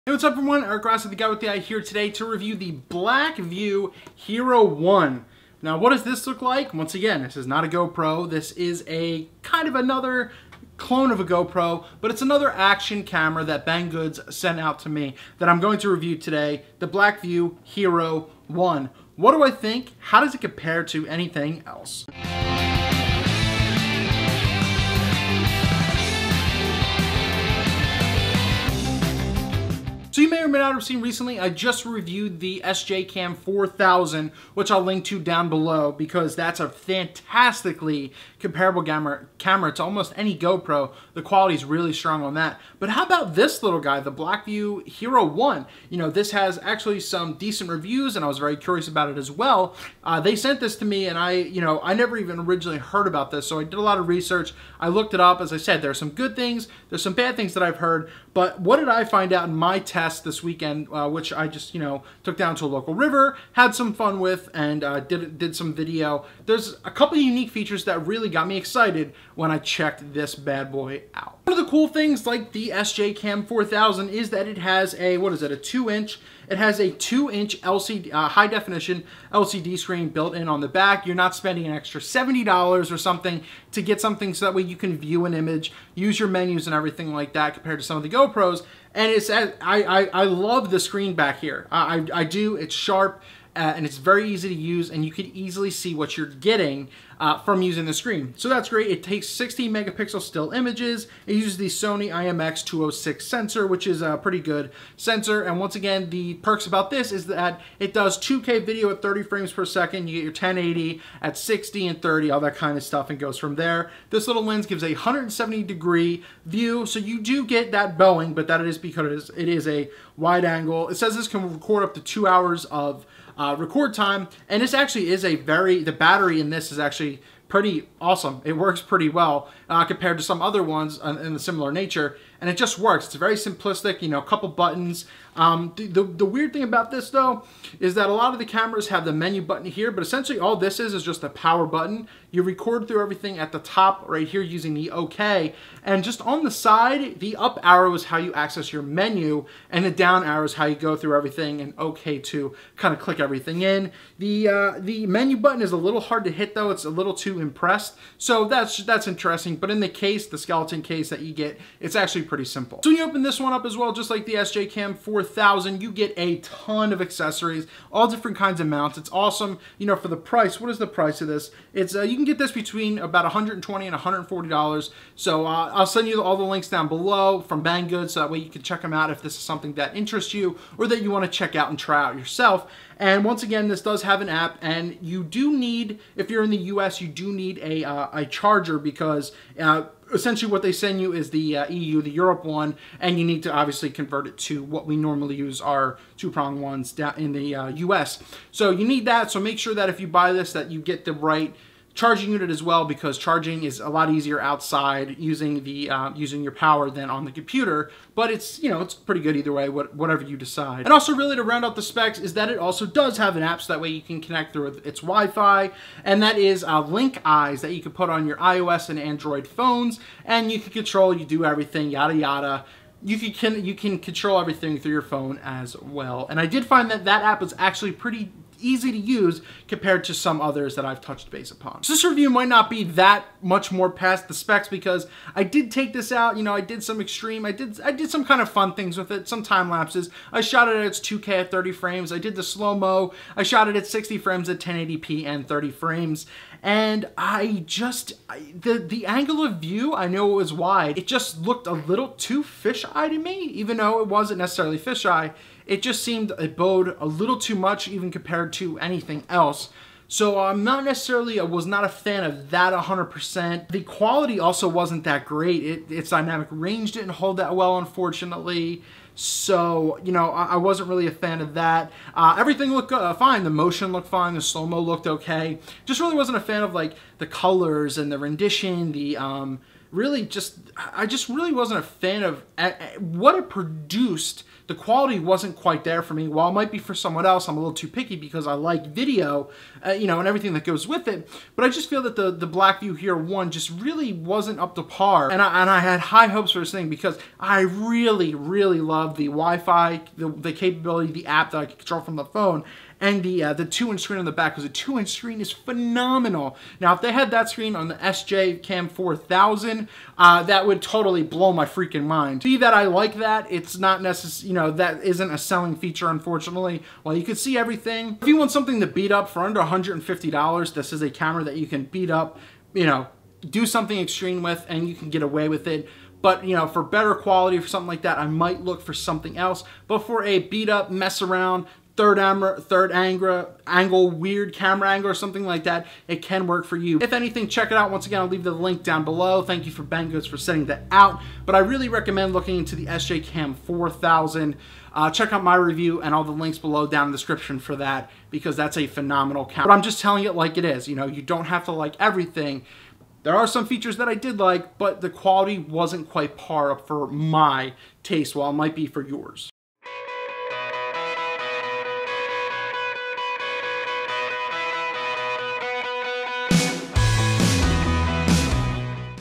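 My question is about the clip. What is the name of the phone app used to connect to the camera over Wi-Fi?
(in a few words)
Link Eyes.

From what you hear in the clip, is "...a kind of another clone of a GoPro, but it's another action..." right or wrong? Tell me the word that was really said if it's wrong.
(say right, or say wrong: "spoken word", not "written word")
right.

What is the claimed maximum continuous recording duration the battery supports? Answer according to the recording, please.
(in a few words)
2 hours.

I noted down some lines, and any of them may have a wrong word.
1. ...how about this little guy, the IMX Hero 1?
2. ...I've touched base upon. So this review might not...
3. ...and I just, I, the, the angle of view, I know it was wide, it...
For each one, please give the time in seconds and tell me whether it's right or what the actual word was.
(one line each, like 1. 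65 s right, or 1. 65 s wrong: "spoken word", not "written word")
1. 42 s wrong: "Blackview", not "IMX"
2. 230 s right
3. 246 s right.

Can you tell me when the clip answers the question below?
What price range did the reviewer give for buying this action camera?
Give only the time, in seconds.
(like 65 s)
172 s.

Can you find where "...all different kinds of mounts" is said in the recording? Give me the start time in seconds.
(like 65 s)
167 s.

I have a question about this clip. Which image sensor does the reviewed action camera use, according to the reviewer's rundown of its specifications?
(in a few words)
Sony IMX 206.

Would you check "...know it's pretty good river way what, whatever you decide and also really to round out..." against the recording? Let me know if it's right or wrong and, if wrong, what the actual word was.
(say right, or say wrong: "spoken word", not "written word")
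wrong: "either", not "river".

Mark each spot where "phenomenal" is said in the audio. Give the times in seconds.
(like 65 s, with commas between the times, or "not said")
305 s, 348 s.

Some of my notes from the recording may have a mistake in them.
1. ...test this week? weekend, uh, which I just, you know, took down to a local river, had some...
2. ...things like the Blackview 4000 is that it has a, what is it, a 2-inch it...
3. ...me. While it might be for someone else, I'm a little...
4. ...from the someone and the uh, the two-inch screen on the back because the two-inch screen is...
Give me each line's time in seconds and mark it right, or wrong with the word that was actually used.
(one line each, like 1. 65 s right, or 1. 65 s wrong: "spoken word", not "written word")
1. 59 s right
2. 71 s wrong: "SJCAM", not "Blackview"
3. 286 s right
4. 301 s wrong: "phone", not "someone".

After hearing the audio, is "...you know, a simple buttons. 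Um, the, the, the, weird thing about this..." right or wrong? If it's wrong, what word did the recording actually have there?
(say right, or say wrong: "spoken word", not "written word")
wrong: "couple", not "simple".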